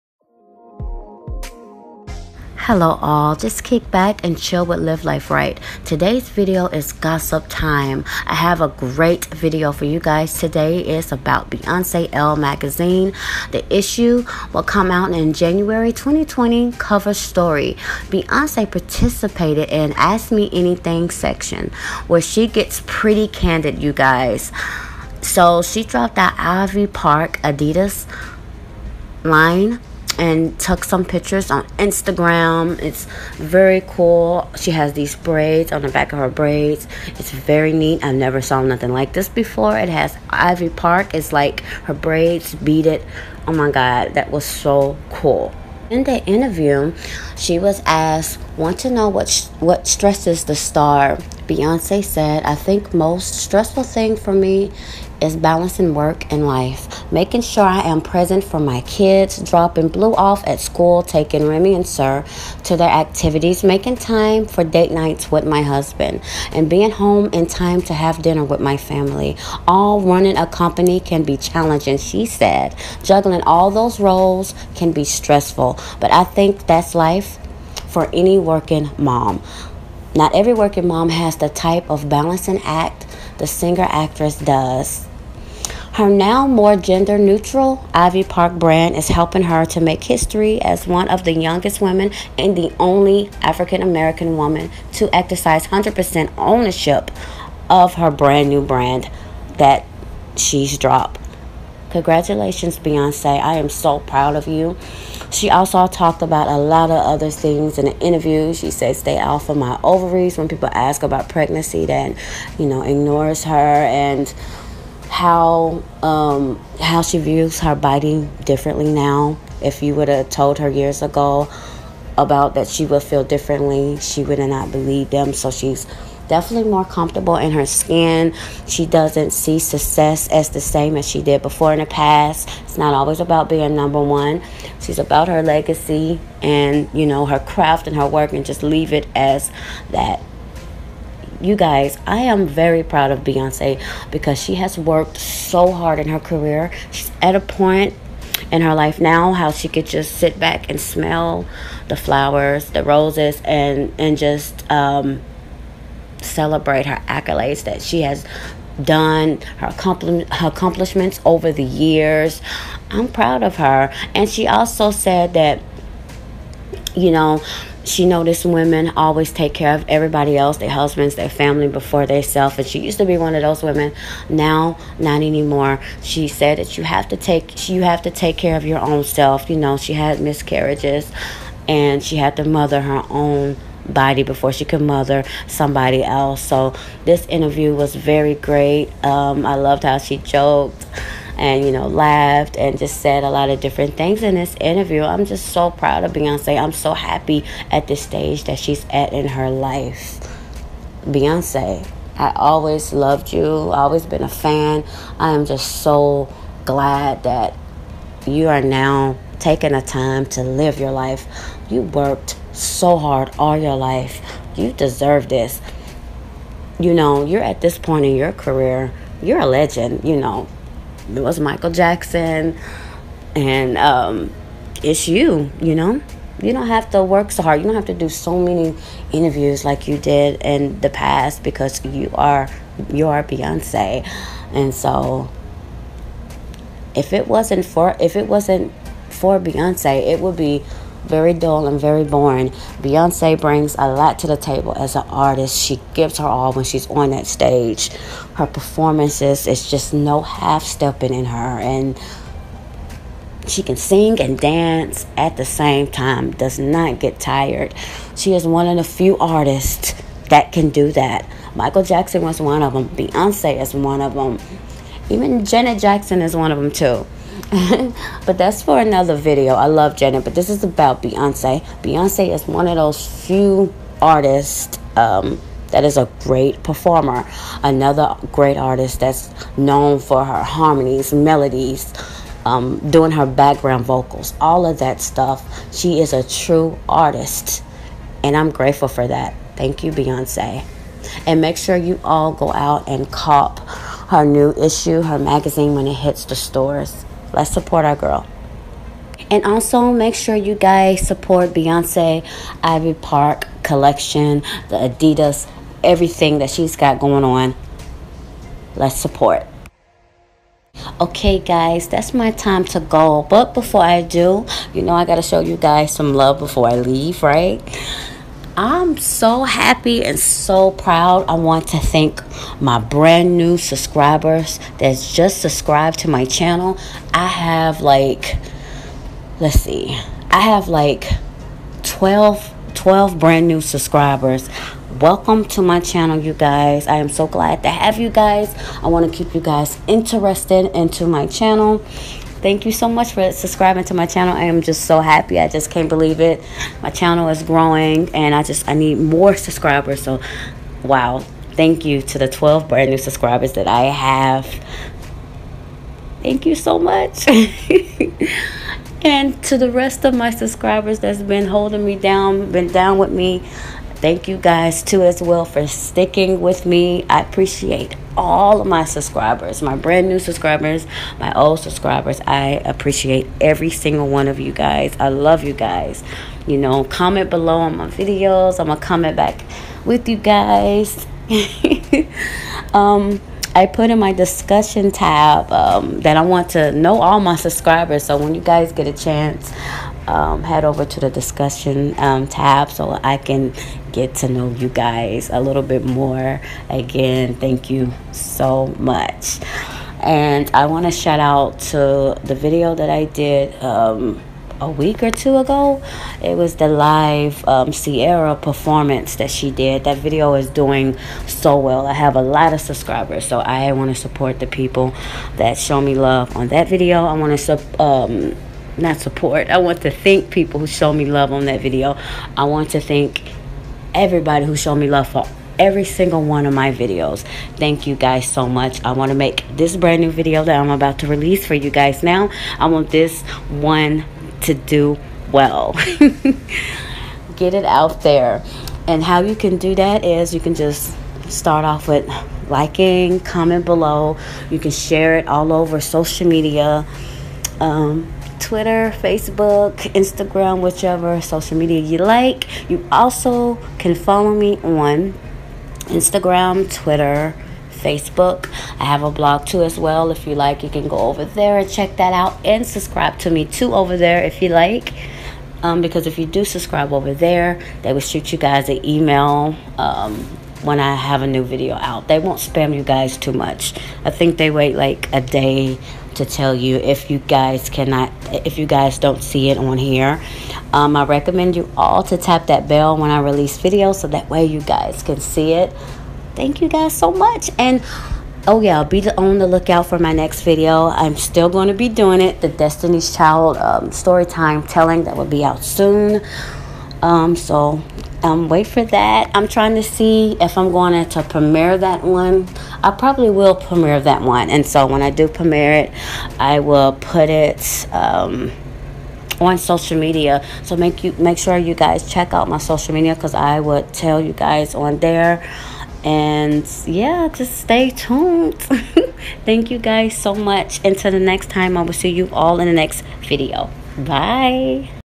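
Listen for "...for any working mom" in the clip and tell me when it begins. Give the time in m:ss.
1:17.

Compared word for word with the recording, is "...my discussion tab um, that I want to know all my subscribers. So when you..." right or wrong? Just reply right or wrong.
right.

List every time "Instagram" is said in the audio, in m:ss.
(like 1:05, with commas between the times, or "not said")
0:31, 7:29, 7:35.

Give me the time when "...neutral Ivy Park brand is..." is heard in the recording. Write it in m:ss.
1:27.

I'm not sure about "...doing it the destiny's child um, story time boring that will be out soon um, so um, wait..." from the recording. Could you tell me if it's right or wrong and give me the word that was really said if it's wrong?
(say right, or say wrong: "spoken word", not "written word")
wrong: "telling", not "boring".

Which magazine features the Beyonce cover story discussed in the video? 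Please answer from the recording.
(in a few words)
Elle.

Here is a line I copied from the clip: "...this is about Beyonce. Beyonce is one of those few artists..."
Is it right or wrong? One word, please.
right.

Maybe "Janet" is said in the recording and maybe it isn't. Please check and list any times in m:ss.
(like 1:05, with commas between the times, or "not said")
4:25, 4:29.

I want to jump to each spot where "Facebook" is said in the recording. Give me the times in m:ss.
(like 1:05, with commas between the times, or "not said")
7:29, 7:37.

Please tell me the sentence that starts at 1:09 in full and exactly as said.
All running a company can be challenging, she said.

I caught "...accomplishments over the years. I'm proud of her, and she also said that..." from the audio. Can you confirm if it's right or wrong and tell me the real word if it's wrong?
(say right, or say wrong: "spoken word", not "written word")
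right.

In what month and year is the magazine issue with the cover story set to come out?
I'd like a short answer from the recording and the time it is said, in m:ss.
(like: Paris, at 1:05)
January 2020, at 0:15.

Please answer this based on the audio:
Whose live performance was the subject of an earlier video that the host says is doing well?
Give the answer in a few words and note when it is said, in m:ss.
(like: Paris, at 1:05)
Ciara, at 6:47.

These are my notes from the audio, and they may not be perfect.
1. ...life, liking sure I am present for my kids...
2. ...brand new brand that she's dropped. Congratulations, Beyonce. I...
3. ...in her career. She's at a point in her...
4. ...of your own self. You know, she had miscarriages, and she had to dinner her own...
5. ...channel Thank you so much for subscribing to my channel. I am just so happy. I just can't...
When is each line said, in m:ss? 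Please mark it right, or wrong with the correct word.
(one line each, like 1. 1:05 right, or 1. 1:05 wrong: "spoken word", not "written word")
1. 0:56 wrong: "making", not "liking"
2. 1:38 right
3. 2:25 right
4. 2:58 wrong: "mother", not "dinner"
5. 5:41 right.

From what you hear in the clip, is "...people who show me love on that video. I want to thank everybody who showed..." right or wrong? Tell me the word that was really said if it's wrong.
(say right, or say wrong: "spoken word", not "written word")
right.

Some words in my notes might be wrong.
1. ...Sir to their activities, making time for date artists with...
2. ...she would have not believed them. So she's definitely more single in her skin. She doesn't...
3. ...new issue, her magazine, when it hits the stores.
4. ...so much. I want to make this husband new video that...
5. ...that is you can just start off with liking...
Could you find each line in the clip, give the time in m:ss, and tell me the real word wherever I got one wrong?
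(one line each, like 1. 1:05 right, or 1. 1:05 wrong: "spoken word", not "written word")
1. 1:01 wrong: "nights", not "artists"
2. 2:03 wrong: "comfortable", not "single"
3. 4:54 right
4. 7:08 wrong: "brand", not "husband"
5. 7:19 right.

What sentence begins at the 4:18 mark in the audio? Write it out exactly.
She is one of the few artists that can do that.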